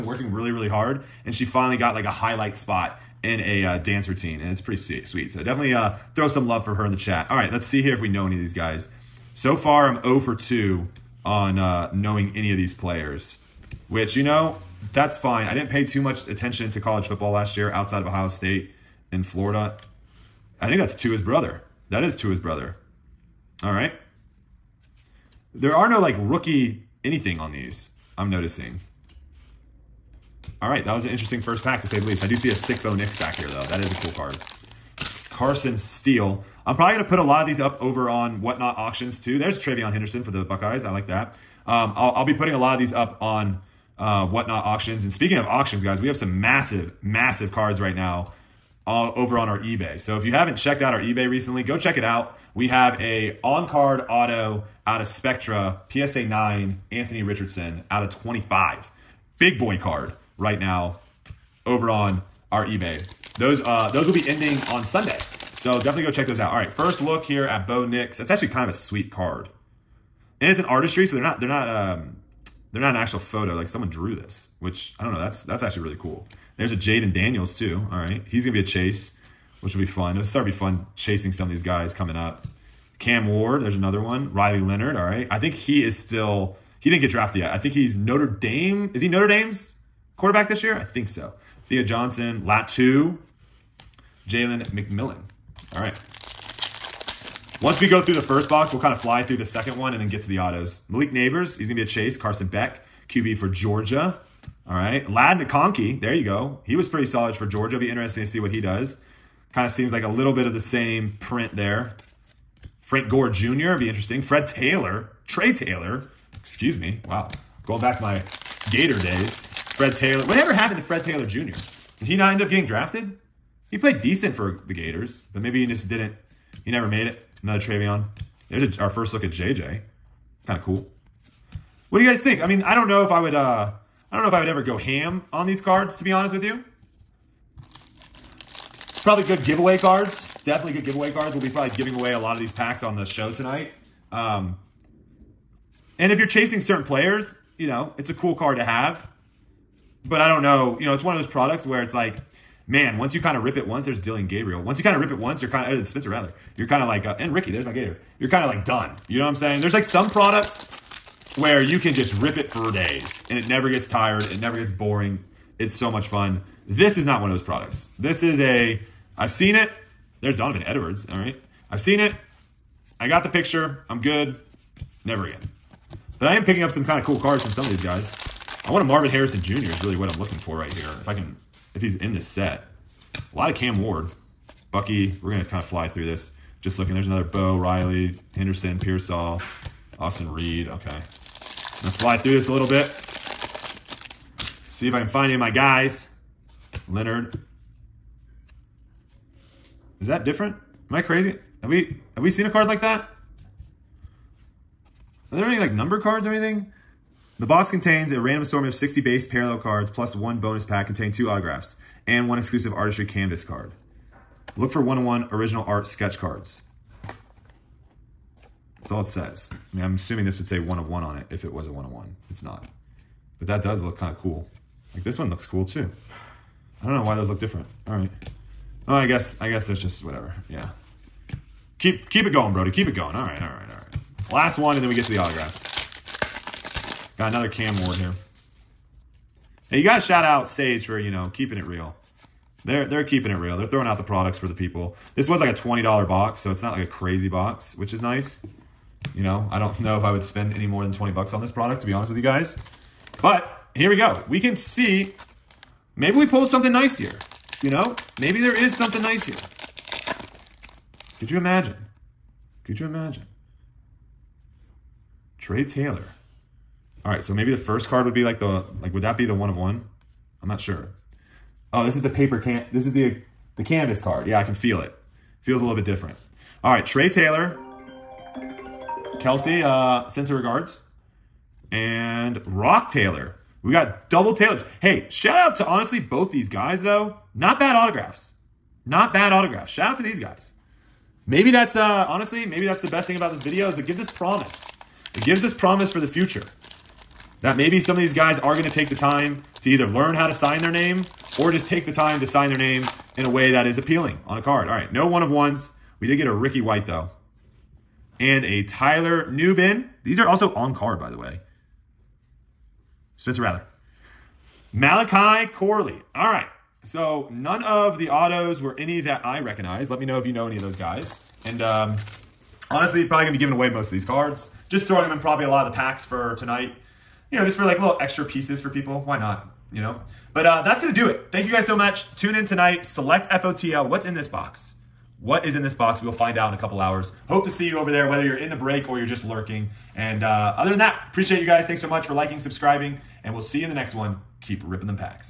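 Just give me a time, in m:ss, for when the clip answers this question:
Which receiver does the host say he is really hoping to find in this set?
2:58.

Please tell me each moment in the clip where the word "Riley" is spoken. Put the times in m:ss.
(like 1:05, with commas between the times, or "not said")
1:24, 3:07.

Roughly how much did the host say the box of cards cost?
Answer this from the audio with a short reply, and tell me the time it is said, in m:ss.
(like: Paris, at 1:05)
$20, at 4:05.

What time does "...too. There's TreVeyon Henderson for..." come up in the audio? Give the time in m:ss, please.
0:39.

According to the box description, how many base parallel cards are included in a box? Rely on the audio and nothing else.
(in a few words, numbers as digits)
60.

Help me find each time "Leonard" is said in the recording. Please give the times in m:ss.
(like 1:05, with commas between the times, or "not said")
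1:24, 3:16.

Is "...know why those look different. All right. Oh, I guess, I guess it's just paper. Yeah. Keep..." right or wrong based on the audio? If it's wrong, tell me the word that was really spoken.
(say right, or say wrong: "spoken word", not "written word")
wrong: "whatever", not "paper".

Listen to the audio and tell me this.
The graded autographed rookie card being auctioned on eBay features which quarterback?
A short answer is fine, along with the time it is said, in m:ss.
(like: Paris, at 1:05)
Anthony Richardson, at 0:56.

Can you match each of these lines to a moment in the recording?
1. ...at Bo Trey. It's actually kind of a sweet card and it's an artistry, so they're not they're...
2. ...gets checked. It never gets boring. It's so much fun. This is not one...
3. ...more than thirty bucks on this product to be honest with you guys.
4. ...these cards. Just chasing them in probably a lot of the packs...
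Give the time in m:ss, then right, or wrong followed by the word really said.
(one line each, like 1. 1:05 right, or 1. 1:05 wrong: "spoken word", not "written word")
1. 1:07 wrong: "Nix", not "Trey"
2. 2:43 wrong: "tired", not "checked"
3. 4:10 wrong: "twenty", not "thirty"
4. 5:23 wrong: "throwing", not "chasing".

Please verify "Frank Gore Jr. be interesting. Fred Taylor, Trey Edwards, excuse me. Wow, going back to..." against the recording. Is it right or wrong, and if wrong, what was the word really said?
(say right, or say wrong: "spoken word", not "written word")
wrong: "Taylor", not "Edwards".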